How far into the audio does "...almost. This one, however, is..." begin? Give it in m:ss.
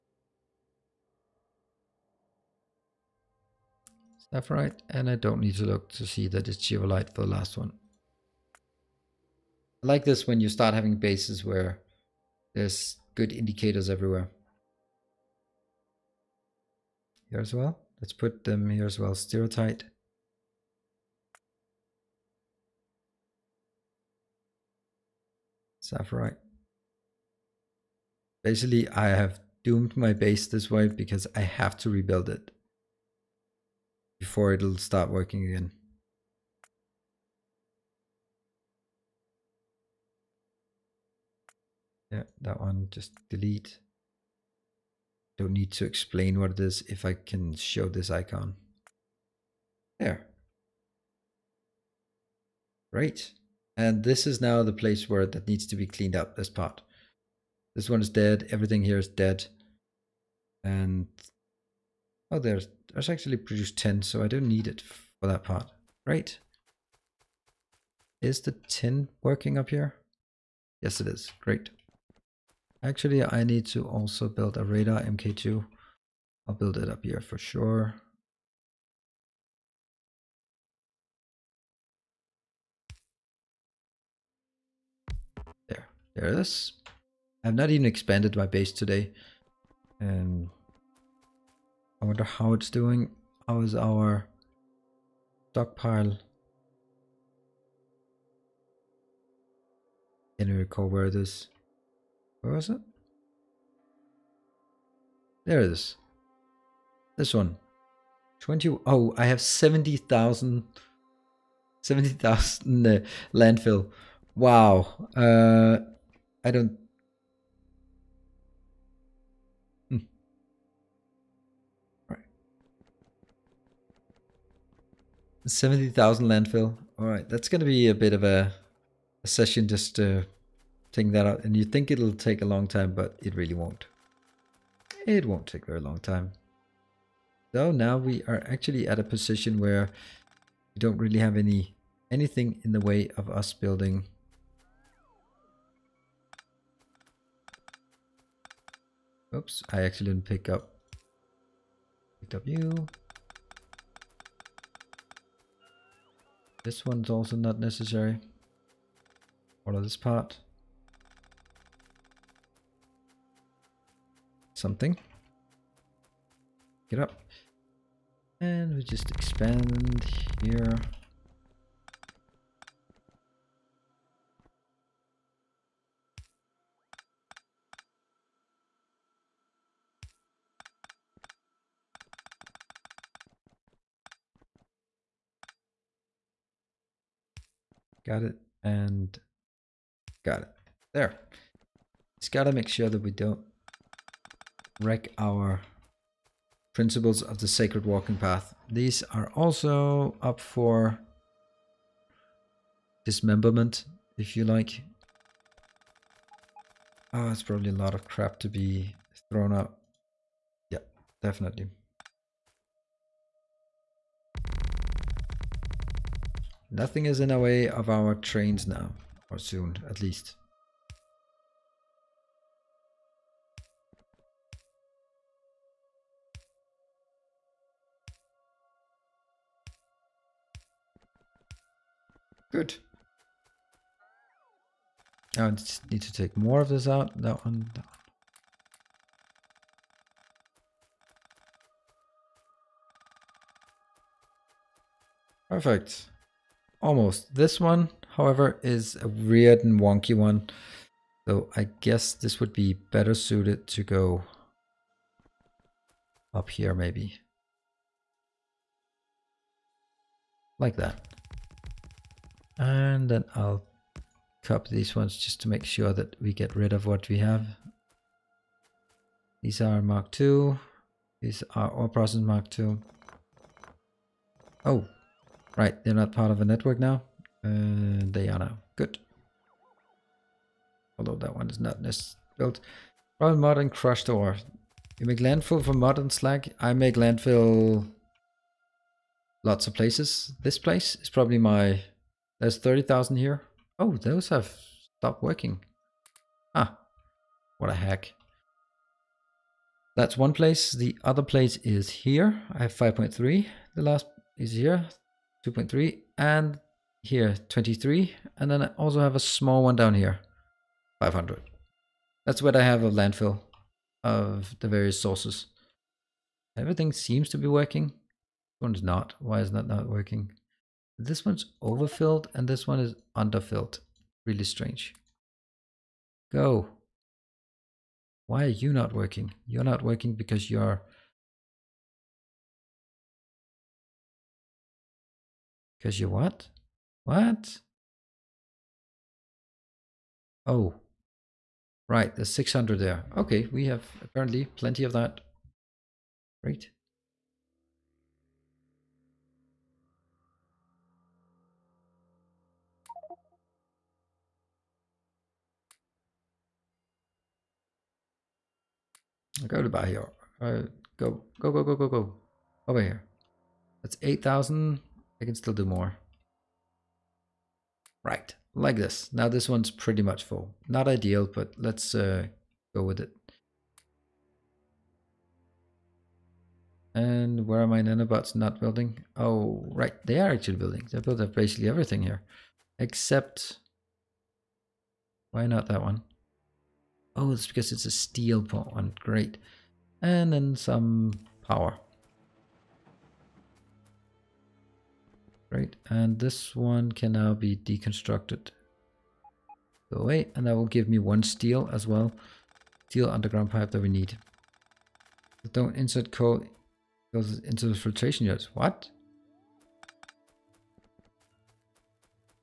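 4:06.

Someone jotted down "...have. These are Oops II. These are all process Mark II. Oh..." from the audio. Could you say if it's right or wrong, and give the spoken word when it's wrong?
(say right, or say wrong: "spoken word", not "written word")
wrong: "Mark", not "Oops".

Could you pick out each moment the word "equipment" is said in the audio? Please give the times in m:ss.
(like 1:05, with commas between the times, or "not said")
not said.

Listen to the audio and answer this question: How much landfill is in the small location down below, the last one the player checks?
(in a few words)
500.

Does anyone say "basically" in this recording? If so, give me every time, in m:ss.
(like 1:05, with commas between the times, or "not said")
0:28, 6:21.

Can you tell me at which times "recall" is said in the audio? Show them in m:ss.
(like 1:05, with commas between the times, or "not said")
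1:40.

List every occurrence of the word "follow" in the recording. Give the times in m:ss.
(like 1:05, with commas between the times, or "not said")
not said.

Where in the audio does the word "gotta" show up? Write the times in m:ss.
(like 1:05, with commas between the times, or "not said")
3:12.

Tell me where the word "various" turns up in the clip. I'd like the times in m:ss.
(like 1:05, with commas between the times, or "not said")
5:14.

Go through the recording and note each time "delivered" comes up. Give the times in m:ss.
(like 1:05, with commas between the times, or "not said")
not said.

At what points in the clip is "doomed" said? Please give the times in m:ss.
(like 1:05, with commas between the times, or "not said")
0:29.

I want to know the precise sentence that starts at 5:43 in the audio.
Okay, we have apparently plenty of that.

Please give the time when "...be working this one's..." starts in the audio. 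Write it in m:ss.
5:17.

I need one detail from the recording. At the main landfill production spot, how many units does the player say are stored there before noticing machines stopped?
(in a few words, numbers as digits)
30,000.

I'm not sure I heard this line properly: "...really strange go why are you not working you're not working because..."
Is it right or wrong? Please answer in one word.
right.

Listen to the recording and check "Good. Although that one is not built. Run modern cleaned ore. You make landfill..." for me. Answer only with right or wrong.
wrong.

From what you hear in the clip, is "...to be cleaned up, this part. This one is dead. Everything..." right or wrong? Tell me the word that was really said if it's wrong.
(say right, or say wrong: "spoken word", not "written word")
right.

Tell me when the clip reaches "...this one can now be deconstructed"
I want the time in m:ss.
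6:36.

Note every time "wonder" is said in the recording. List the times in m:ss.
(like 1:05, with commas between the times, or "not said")
1:32.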